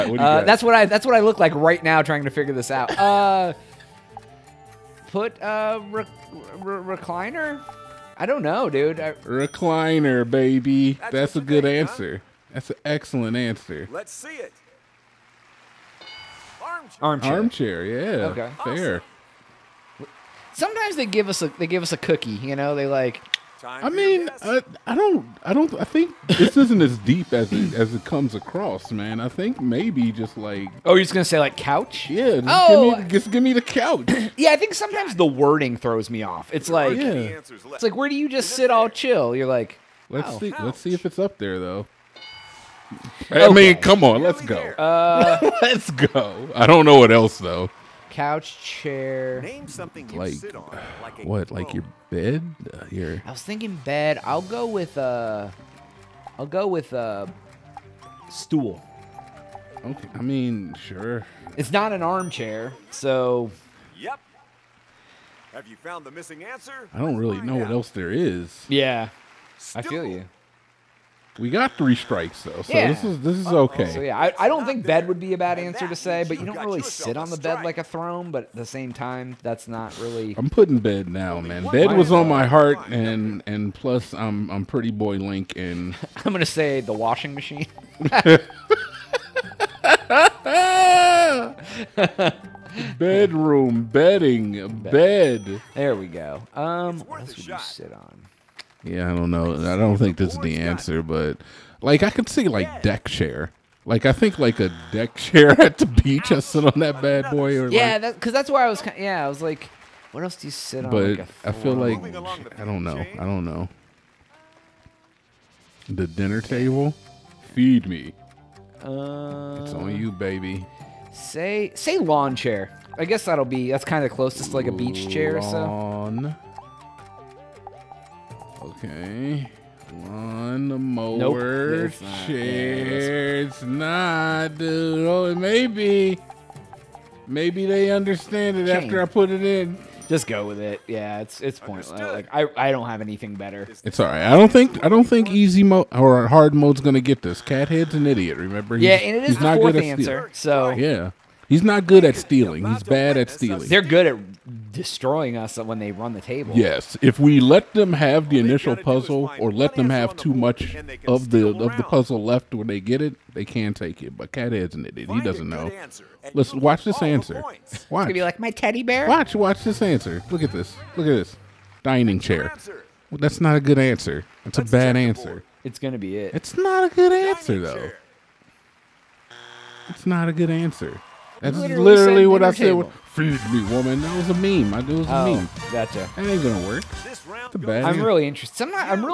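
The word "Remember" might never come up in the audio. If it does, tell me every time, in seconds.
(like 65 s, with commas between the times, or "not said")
148 s.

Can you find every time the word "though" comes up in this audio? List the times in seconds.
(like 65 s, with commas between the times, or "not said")
41 s, 47 s, 72 s, 177 s.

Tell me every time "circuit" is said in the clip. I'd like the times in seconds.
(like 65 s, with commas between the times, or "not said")
not said.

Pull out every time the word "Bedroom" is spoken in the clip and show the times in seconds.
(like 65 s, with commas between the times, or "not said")
92 s.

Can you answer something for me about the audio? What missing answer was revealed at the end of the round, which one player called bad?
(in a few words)
Dining chair.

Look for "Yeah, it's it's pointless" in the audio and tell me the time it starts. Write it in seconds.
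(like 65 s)
140 s.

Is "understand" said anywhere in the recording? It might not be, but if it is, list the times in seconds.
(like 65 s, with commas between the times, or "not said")
137 s.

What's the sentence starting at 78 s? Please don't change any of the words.
But at the same time, that's not really.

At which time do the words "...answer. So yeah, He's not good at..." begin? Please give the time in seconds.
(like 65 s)
149 s.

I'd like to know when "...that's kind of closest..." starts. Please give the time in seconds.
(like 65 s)
123 s.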